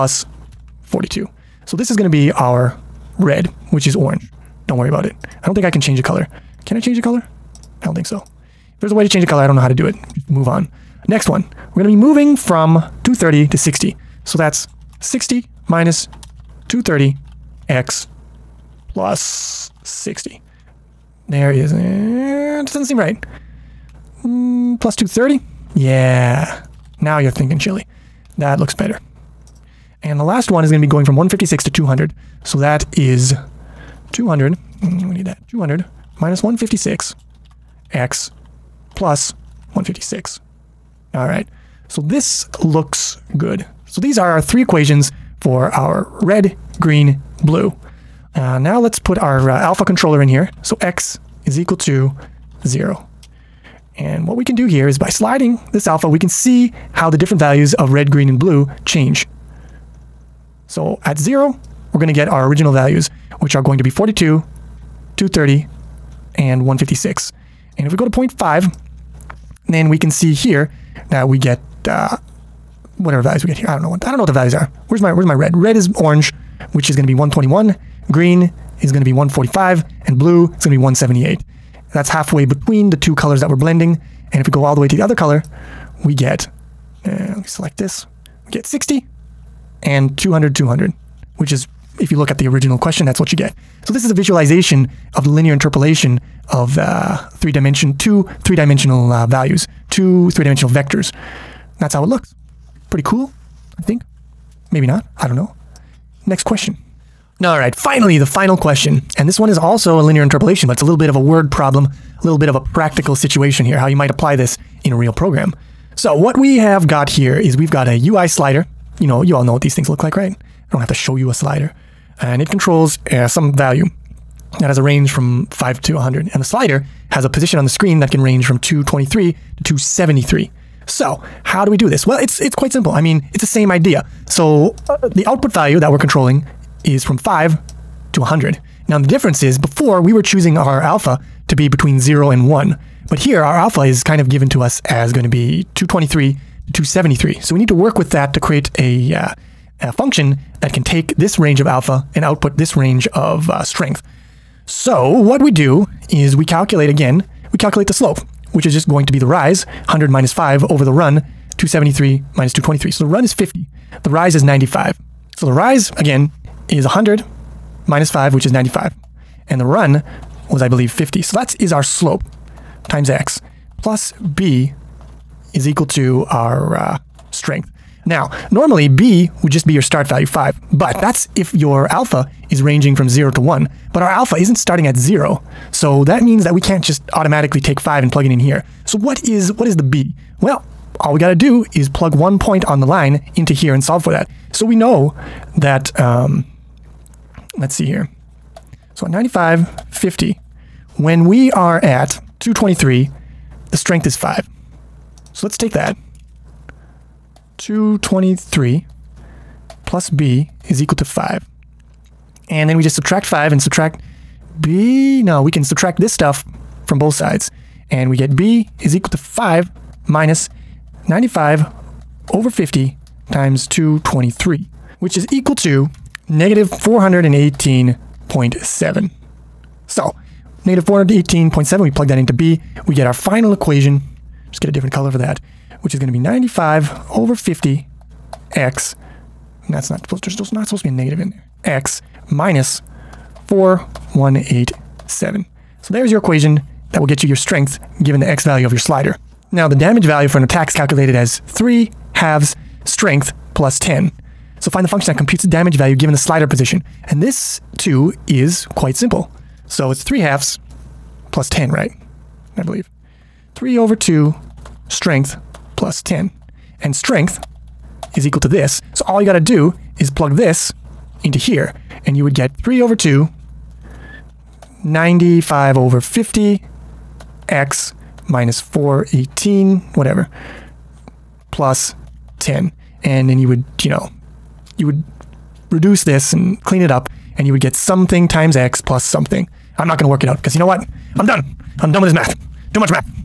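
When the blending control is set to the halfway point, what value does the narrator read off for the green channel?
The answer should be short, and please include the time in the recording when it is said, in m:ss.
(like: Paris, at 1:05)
145, at 1:19.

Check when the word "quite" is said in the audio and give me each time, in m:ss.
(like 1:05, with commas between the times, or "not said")
2:12, 4:18.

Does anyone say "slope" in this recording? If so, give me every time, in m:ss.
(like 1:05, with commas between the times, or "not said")
2:37, 2:51.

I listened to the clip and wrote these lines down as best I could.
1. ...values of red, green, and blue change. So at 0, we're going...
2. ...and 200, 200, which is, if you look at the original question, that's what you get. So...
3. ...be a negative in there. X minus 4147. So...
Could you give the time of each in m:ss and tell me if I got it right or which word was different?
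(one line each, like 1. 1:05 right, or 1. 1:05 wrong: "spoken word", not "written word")
1. 0:57 right
2. 1:29 right
3. 4:00 wrong: "4187", not "4147".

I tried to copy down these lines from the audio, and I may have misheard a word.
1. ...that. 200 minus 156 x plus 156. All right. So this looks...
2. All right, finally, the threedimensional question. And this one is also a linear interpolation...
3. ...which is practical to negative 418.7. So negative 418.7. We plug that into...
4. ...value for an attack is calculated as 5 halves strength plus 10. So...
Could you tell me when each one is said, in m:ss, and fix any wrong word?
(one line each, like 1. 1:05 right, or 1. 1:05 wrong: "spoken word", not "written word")
1. 0:35 right
2. 1:47 wrong: "final", not "threedimensional"
3. 3:45 wrong: "equal", not "practical"
4. 4:10 wrong: "3", not "5".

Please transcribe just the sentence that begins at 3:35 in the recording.
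No, we can subtract this stuff from both sides.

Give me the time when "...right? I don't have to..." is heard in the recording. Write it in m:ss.
2:00.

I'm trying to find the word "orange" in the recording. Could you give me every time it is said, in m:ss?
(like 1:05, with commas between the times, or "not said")
0:03, 1:15.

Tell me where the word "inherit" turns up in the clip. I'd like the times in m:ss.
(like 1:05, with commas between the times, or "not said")
not said.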